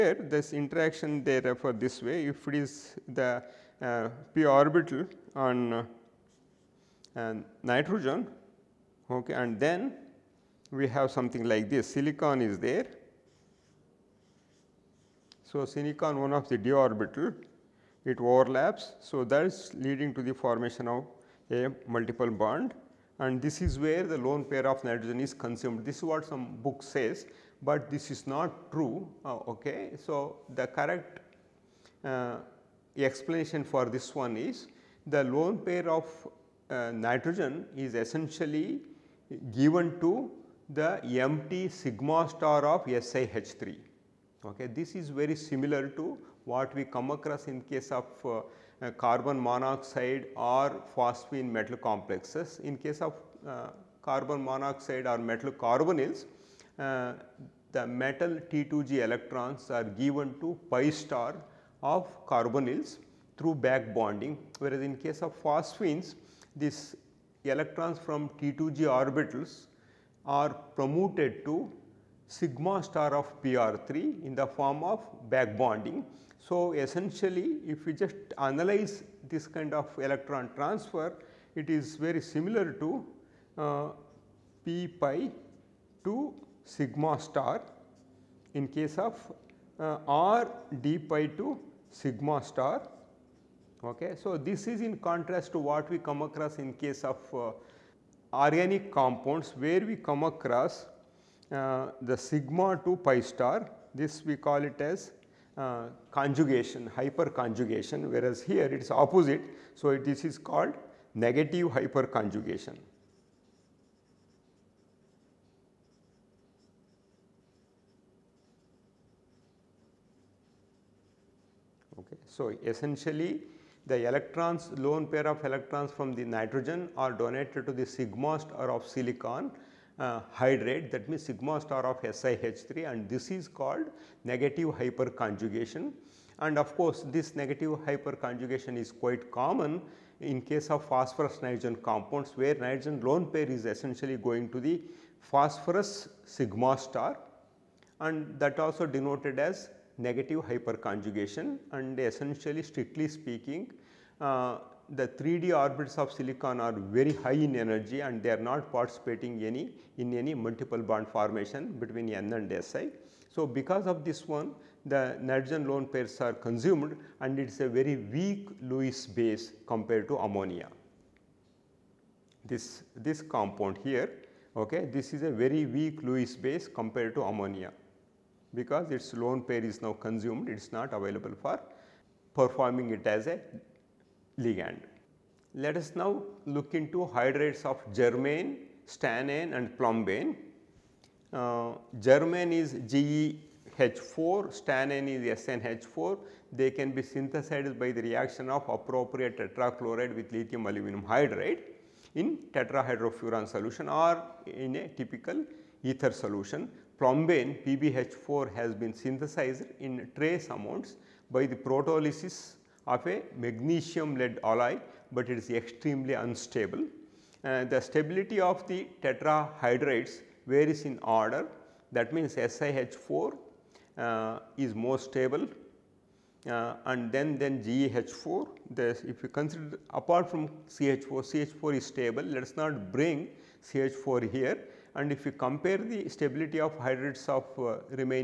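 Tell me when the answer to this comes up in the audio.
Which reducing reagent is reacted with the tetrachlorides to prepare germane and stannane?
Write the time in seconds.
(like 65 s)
200 s.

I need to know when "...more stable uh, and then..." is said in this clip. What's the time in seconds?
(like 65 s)
224 s.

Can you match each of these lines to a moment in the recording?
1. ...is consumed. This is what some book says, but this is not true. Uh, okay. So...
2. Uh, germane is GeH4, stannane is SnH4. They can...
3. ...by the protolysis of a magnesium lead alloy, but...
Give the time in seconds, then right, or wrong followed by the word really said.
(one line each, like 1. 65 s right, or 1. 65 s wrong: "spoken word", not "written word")
1. 25 s right
2. 191 s right
3. 211 s right.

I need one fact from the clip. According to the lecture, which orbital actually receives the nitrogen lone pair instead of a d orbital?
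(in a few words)
sigma star of SiH3.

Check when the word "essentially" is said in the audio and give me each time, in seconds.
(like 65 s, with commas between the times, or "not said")
37 s, 76 s, 122 s, 143 s, 151 s.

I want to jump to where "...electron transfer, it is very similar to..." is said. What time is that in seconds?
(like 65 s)
79 s.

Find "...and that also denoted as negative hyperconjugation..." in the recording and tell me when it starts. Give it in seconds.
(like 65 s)
147 s.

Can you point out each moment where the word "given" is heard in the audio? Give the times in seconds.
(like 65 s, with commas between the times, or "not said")
39 s, 59 s.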